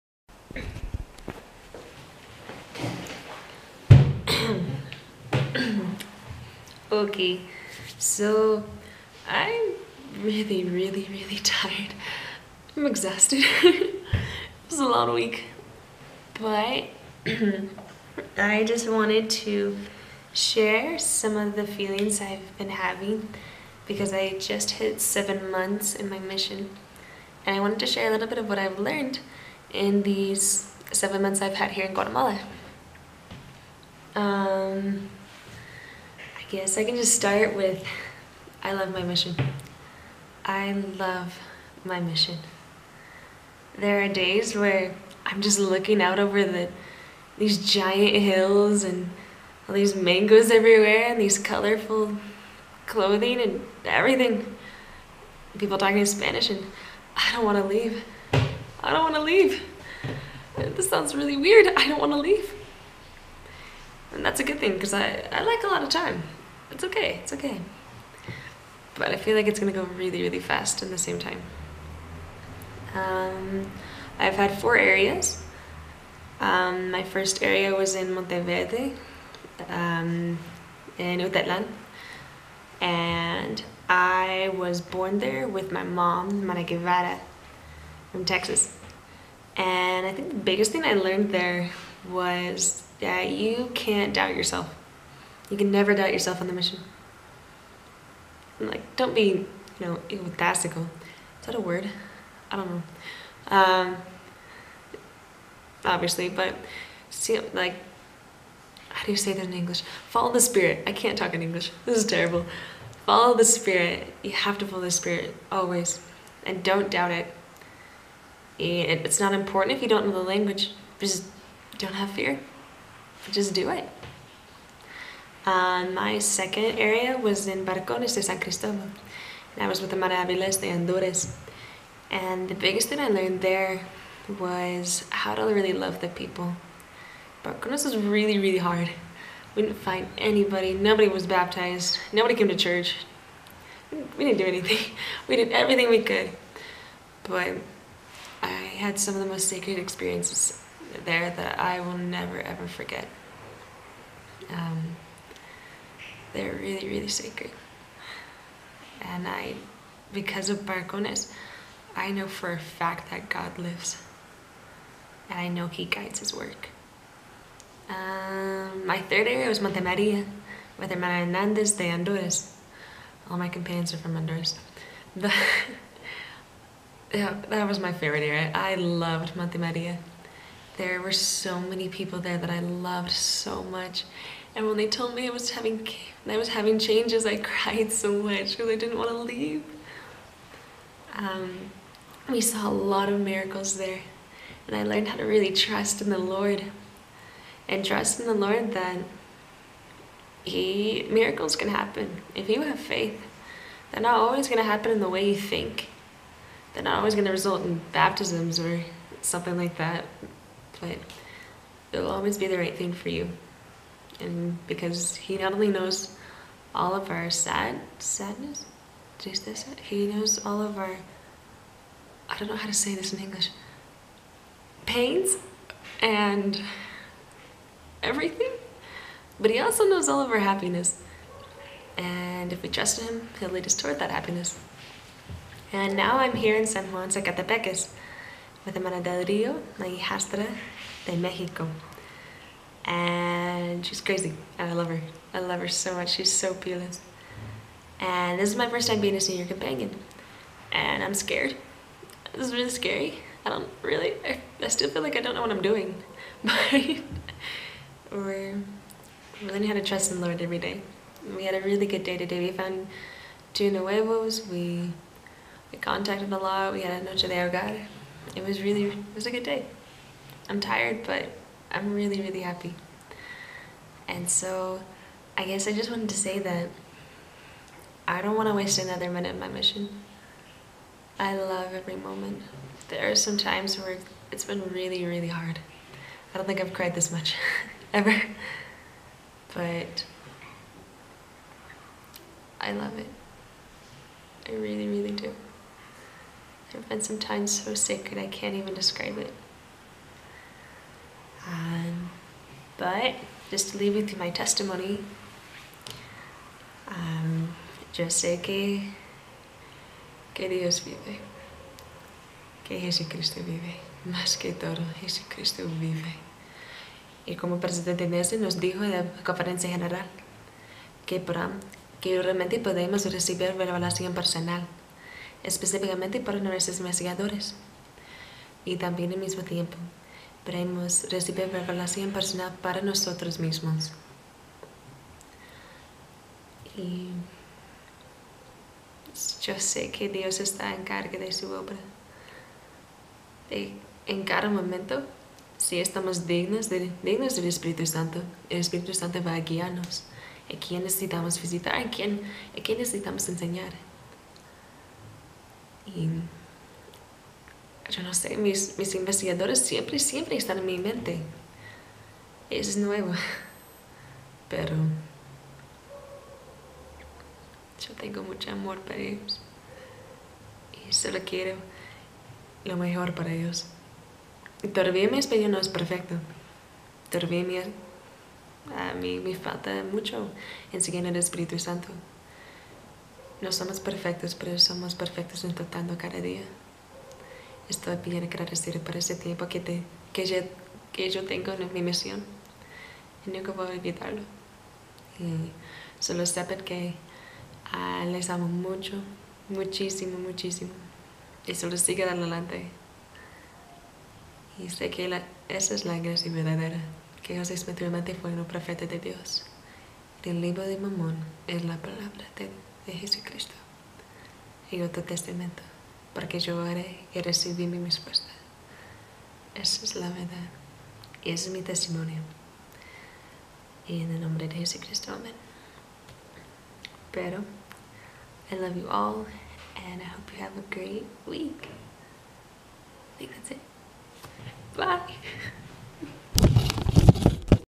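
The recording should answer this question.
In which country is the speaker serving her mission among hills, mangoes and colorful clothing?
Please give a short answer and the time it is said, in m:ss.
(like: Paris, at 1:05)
Guatemala, at 0:31.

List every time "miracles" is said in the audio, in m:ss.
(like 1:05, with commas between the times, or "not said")
3:13, 3:21.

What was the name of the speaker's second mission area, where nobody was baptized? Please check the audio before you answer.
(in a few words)
Barcones de San Cristobal.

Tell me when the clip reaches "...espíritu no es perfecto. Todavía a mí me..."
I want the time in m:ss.
6:15.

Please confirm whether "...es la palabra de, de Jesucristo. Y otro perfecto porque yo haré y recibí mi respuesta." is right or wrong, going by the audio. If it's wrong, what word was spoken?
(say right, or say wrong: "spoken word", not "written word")
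wrong: "testamento", not "perfecto".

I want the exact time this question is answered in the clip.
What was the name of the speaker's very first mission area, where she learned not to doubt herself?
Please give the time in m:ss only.
1:18.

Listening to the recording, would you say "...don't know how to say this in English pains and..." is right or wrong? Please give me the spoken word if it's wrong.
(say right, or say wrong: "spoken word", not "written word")
right.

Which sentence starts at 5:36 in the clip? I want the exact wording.
Y yo sé que Dios está en carga de su obra.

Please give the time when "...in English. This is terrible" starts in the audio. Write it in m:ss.
1:51.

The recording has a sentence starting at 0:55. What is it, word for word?
People talking in Spanish and I don't want to leave.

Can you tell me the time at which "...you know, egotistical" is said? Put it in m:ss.
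1:39.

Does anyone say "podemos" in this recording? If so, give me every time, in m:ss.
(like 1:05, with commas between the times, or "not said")
5:22, 5:30.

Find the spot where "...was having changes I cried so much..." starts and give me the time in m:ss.
3:06.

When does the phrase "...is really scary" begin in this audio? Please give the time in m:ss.
4:12.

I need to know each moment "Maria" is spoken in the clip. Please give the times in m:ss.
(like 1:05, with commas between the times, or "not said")
2:49, 2:59.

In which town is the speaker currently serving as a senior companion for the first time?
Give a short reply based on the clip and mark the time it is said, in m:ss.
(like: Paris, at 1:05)
San Juan Sacatepéquez, at 3:56.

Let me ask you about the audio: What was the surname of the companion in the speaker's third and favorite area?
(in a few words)
Hernandez.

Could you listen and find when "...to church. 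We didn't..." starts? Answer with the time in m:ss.
2:22.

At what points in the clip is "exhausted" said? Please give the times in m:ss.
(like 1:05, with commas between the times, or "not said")
0:12.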